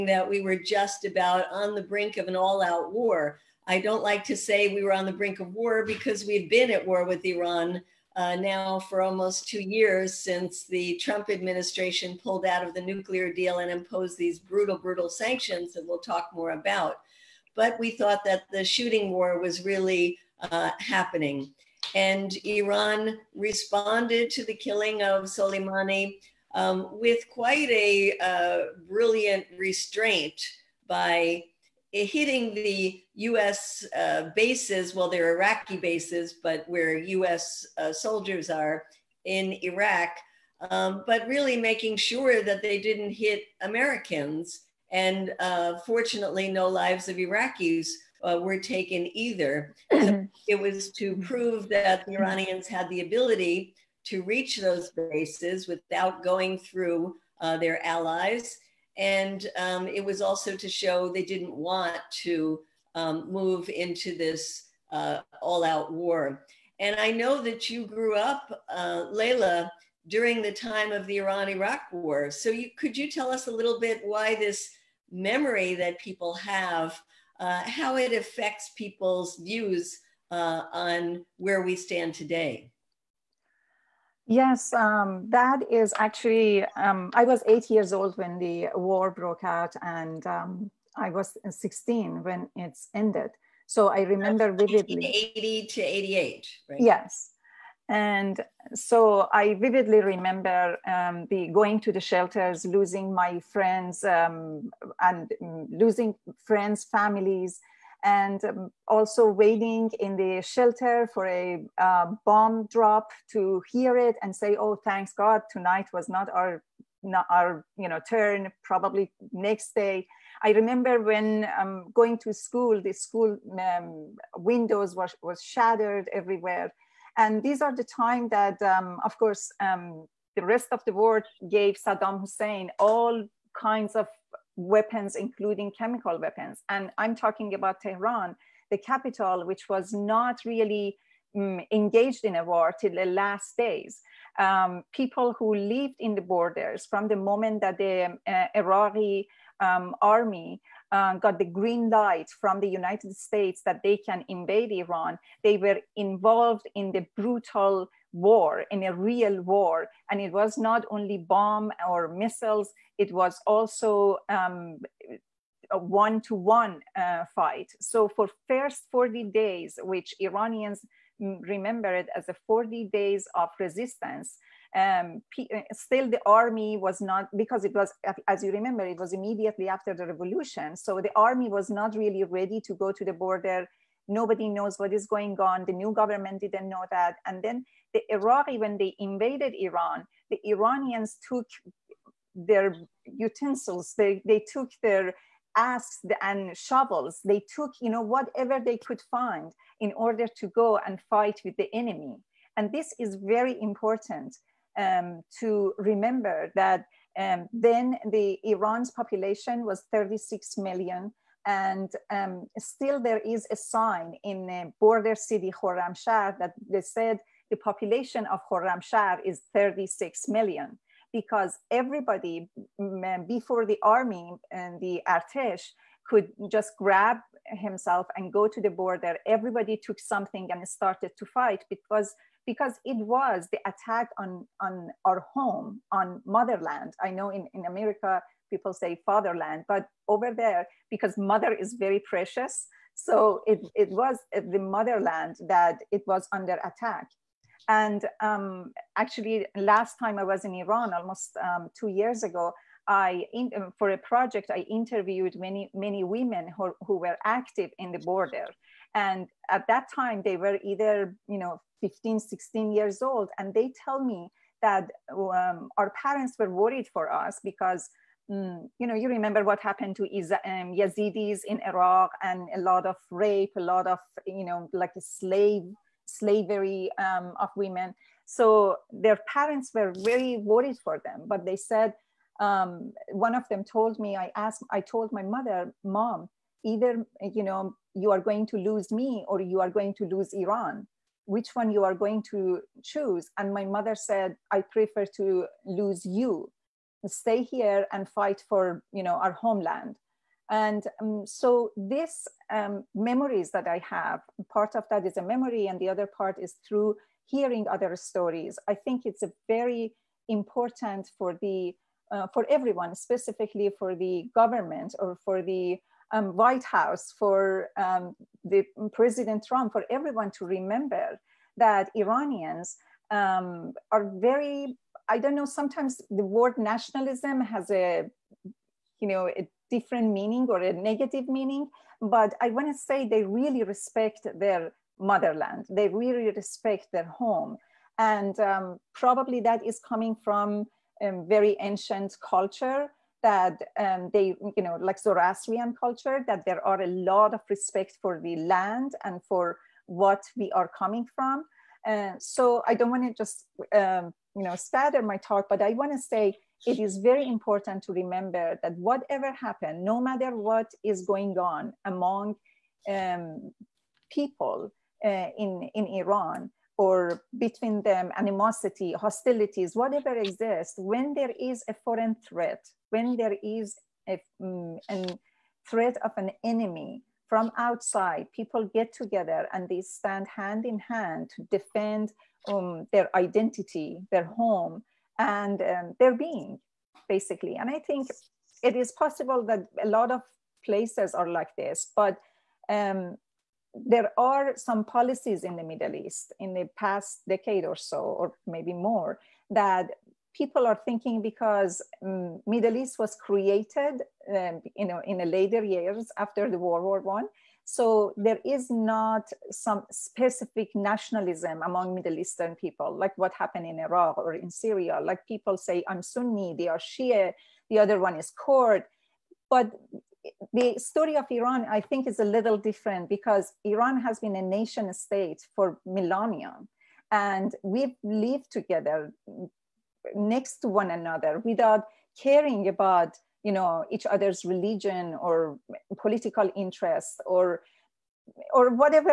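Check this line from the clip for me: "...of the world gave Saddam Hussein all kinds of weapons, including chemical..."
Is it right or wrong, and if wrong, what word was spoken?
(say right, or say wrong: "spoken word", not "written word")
right.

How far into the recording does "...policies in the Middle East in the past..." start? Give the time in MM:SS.
06:34.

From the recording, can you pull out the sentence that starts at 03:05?
The new government didn't know that.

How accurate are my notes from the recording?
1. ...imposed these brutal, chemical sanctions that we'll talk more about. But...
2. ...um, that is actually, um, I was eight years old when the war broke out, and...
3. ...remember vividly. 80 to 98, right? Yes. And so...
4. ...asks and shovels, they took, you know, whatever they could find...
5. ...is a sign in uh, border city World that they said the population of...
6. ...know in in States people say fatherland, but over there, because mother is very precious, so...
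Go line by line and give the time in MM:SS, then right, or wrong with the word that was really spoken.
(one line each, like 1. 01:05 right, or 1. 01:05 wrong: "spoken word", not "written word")
1. 00:13 wrong: "brutal", not "chemical"
2. 01:24 right
3. 01:34 wrong: "88", not "98"
4. 03:15 right
5. 03:33 wrong: "Khorramshahr", not "World"
6. 03:57 wrong: "America", not "States".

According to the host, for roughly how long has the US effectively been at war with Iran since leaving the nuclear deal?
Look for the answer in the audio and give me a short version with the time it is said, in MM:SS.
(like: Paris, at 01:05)
almost two years, at 00:09.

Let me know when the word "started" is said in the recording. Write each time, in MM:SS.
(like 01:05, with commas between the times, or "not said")
03:50, 05:54.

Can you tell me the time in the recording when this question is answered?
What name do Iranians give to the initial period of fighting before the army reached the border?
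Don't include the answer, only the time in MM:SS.
02:52.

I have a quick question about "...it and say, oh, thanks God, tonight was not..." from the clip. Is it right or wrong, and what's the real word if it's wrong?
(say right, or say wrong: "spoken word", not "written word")
right.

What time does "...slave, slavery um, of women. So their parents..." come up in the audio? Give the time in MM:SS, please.
04:35.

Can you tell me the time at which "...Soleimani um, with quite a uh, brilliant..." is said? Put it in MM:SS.
00:25.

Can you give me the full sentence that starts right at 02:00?
I remember when um, going to school, the school um, windows was, was shattered everywhere.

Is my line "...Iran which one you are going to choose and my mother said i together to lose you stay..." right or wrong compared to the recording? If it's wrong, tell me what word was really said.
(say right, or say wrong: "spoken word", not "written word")
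wrong: "prefer", not "together".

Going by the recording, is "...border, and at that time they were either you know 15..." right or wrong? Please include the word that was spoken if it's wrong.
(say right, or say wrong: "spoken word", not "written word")
right.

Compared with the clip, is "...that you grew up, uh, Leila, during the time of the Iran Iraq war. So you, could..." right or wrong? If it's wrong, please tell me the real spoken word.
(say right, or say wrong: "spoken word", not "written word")
right.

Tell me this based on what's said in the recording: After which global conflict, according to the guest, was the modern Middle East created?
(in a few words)
World War One.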